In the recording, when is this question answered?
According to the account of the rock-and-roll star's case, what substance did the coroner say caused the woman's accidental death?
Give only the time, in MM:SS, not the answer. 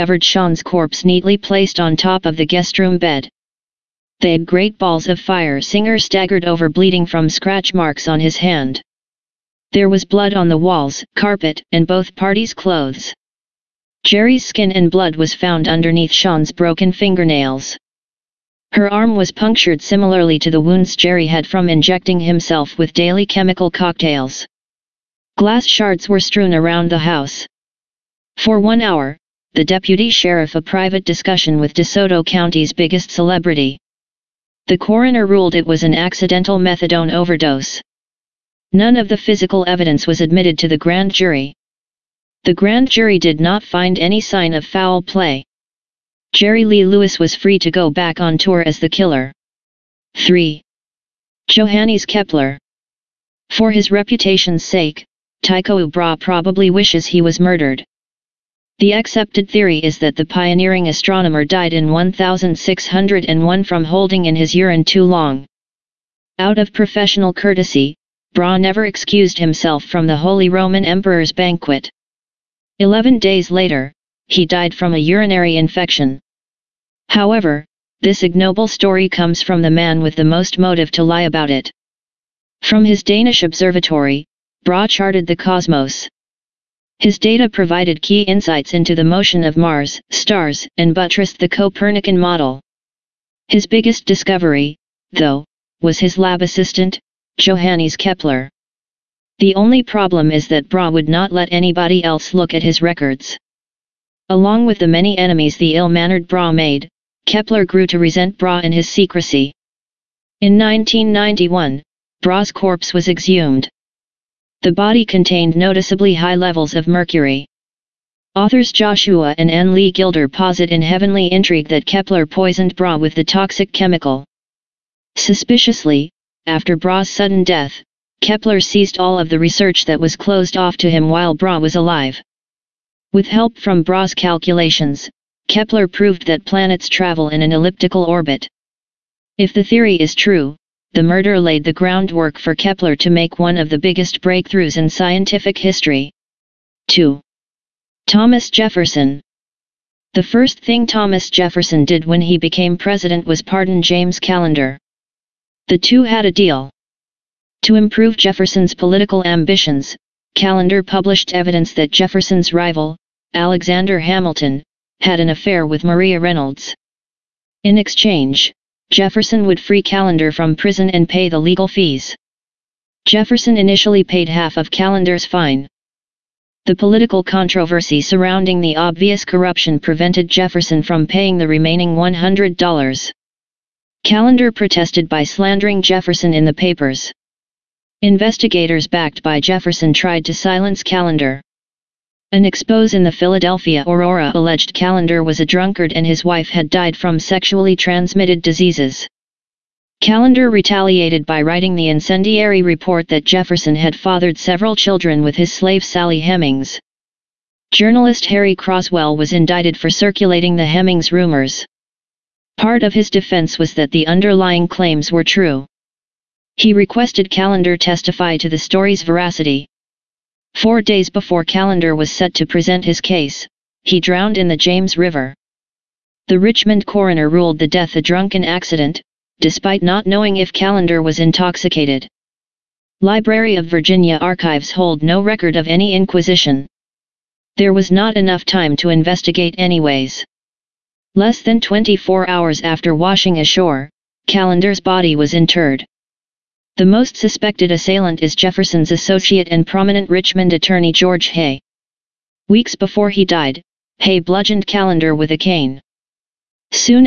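00:36.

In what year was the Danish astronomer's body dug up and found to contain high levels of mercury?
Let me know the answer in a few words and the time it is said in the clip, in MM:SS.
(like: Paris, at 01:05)
1991, at 01:50.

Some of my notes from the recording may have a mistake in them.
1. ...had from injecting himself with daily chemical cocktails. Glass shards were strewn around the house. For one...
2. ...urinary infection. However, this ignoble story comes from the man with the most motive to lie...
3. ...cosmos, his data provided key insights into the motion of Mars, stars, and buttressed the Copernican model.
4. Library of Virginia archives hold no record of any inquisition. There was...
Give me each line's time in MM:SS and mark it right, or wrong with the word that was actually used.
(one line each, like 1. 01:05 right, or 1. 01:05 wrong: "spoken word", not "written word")
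1. 00:21 right
2. 01:14 right
3. 01:25 right
4. 03:53 right.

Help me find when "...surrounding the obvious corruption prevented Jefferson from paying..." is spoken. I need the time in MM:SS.
02:58.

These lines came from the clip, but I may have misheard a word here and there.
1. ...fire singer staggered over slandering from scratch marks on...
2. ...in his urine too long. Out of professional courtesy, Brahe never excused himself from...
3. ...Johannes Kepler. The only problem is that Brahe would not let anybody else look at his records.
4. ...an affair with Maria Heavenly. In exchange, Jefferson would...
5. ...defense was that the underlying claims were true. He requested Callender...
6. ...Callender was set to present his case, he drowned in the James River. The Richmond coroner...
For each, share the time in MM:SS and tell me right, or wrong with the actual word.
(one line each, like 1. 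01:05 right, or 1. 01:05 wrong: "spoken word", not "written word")
1. 00:05 wrong: "bleeding", not "slandering"
2. 01:04 right
3. 01:37 right
4. 02:45 wrong: "Reynolds", not "Heavenly"
5. 03:33 right
6. 03:41 right.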